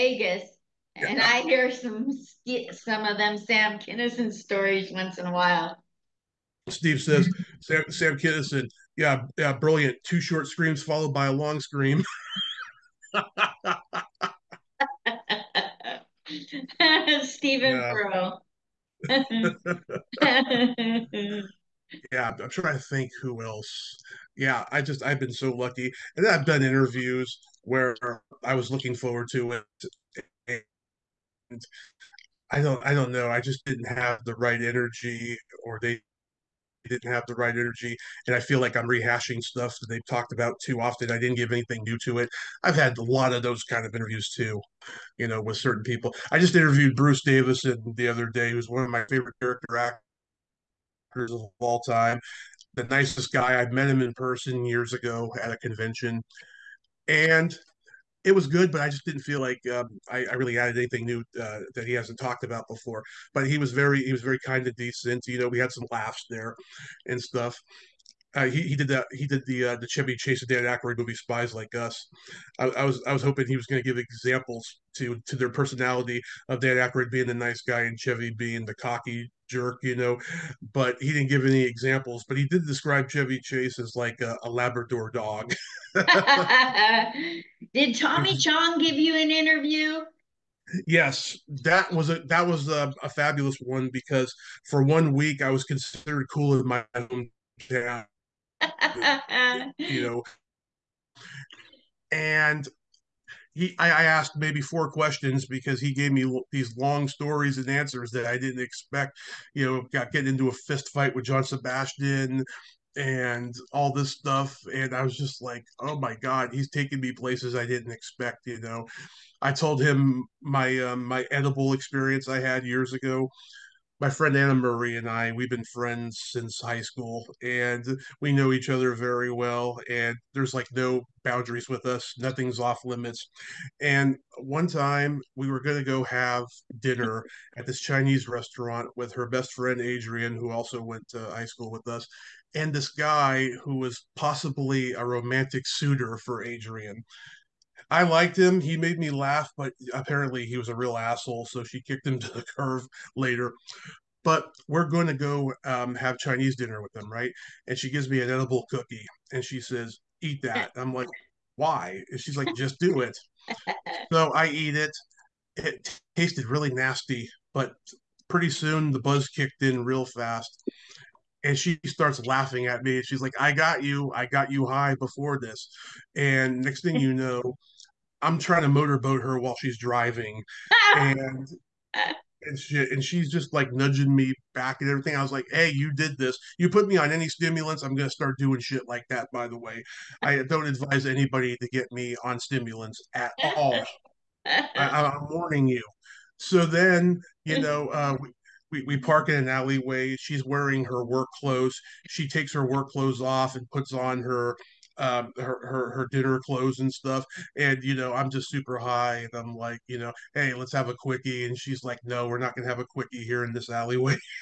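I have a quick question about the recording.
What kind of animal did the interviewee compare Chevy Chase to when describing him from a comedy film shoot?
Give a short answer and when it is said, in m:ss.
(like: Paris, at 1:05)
Labrador, at 1:24.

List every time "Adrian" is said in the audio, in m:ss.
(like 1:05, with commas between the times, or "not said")
2:19, 2:26.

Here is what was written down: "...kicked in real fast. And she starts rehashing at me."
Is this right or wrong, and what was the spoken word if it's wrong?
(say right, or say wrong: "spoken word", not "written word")
wrong: "laughing", not "rehashing".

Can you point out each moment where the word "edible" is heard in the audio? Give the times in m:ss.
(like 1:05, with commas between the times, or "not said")
2:01, 2:38.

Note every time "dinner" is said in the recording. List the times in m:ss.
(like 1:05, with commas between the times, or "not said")
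2:16, 2:36, 3:26.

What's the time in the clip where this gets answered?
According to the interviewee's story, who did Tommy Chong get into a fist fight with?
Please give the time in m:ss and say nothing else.
1:51.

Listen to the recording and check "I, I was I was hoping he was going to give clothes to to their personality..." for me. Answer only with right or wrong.
wrong.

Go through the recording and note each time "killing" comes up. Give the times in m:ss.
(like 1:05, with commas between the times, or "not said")
not said.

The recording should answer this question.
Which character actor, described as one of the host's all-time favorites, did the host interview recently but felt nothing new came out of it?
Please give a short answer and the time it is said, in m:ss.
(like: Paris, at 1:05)
Bruce Davison, at 0:46.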